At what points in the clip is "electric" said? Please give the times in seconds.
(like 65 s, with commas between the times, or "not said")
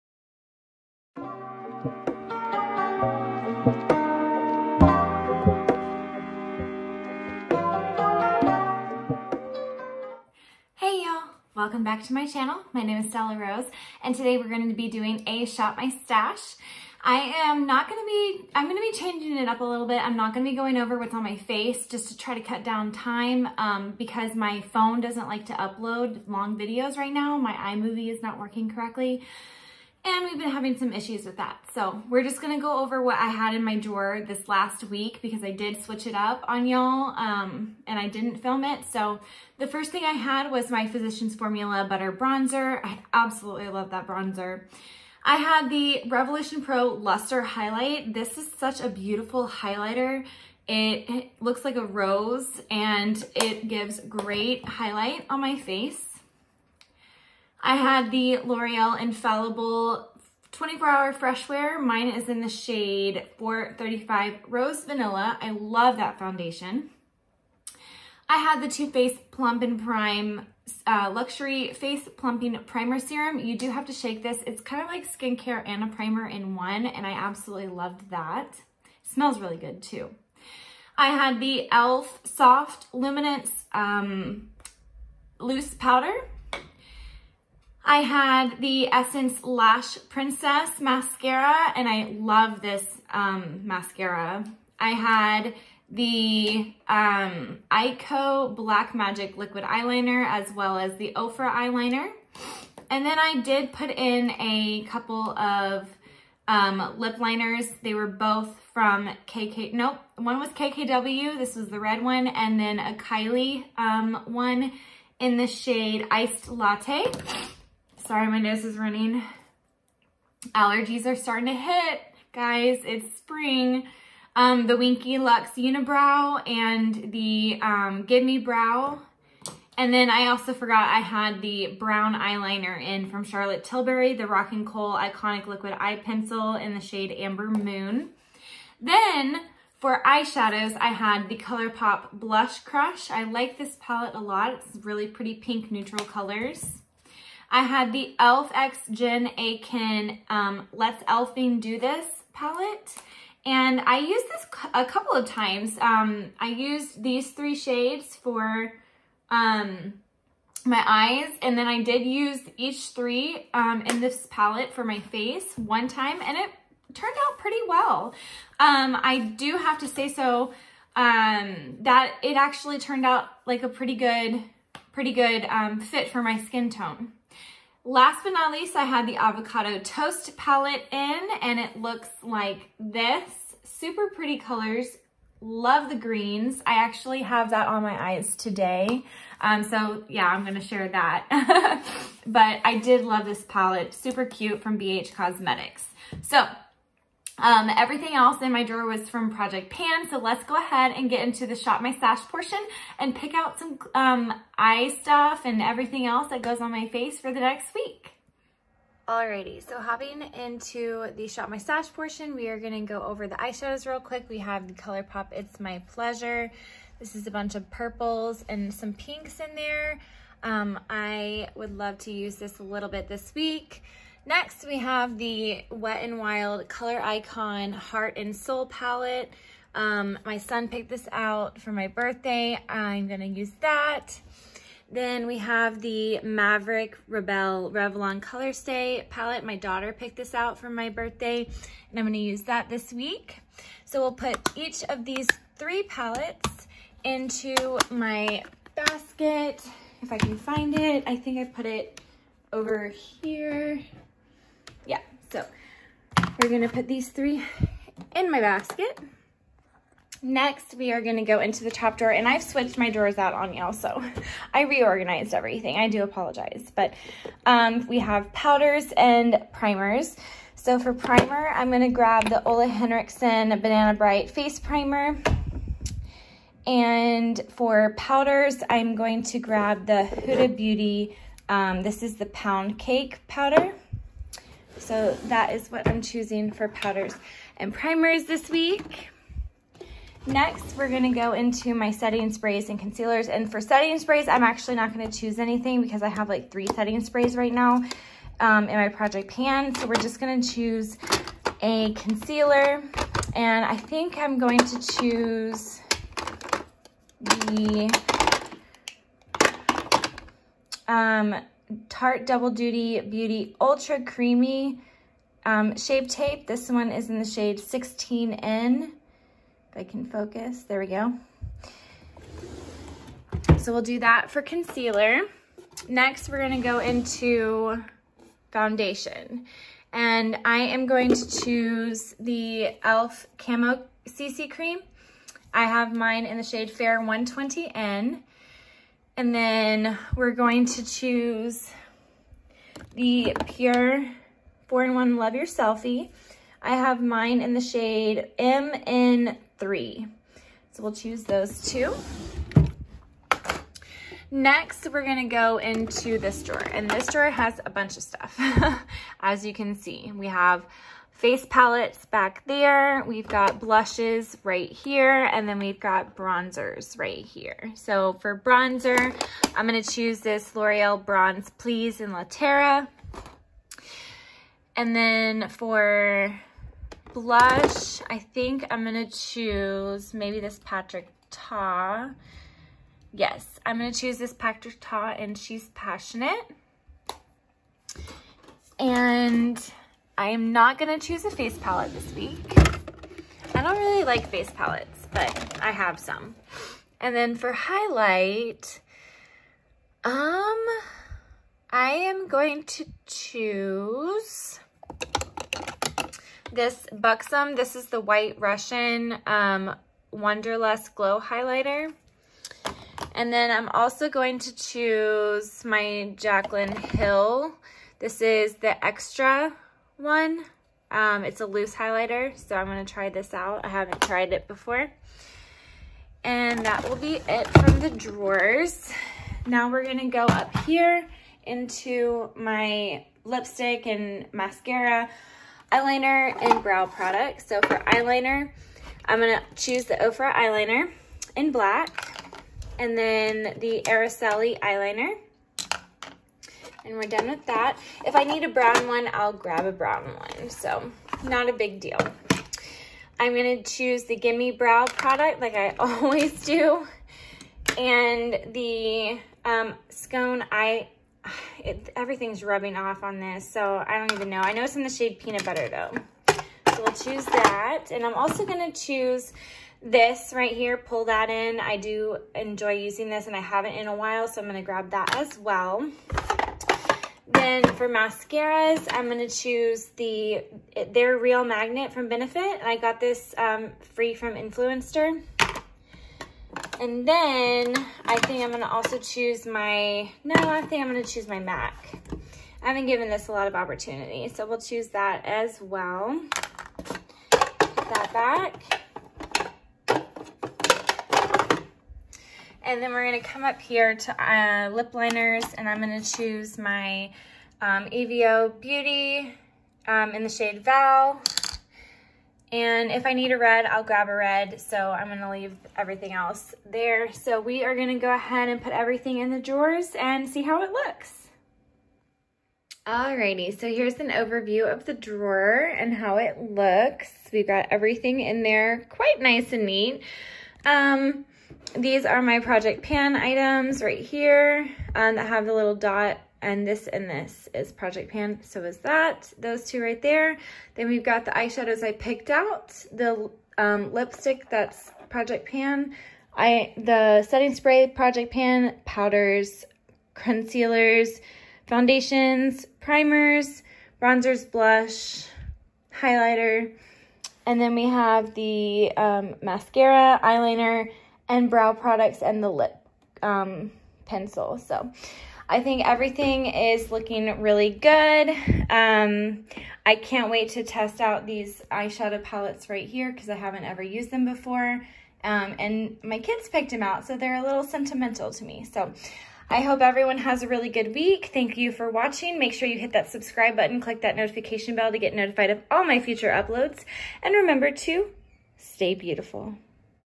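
not said.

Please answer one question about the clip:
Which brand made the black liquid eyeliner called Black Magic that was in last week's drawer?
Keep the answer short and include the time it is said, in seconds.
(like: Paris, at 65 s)
Eyeko, at 97 s.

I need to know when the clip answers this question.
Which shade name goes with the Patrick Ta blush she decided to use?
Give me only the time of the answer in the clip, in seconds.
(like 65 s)
385 s.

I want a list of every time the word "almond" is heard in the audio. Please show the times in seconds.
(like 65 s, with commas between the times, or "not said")
not said.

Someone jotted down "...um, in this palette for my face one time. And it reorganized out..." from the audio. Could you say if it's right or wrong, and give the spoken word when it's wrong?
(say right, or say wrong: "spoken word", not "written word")
wrong: "turned", not "reorganized".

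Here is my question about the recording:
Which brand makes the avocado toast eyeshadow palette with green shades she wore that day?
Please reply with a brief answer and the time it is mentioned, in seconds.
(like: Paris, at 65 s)
BH Cosmetics, at 194 s.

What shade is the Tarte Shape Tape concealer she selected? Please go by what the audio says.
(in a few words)
16N.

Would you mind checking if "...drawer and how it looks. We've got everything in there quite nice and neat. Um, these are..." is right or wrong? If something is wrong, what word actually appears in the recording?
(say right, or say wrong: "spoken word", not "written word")
right.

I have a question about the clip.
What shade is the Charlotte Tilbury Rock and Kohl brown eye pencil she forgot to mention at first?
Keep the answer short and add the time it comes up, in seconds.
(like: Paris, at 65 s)
Amber Moon, at 137 s.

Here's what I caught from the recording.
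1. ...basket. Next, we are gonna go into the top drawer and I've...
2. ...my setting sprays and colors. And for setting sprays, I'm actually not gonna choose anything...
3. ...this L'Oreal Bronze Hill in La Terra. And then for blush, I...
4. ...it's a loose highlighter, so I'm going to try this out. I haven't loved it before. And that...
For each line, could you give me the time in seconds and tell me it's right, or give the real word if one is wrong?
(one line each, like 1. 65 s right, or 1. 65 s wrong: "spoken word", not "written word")
1. 258 s right
2. 291 s wrong: "concealers", not "colors"
3. 370 s wrong: "Please", not "Hill"
4. 421 s wrong: "tried", not "loved".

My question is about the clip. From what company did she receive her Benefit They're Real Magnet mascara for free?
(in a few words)
Influenster.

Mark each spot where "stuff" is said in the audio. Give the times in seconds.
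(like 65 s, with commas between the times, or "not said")
205 s, 358 s.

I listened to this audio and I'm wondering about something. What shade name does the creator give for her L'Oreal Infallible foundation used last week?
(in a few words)
Rose Vanilla.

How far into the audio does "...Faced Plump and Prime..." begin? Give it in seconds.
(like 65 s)
68 s.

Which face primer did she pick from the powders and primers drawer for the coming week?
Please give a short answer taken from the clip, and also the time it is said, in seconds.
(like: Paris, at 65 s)
Ole Henriksen Banana Bright, at 272 s.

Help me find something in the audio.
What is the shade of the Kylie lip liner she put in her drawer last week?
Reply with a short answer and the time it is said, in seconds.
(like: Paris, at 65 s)
Iced Latte, at 116 s.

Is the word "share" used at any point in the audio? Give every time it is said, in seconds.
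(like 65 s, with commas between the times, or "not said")
190 s.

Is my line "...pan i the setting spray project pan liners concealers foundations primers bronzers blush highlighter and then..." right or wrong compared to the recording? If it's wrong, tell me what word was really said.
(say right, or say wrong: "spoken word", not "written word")
wrong: "powders", not "liners".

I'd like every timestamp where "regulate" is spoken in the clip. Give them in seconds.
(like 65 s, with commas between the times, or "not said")
not said.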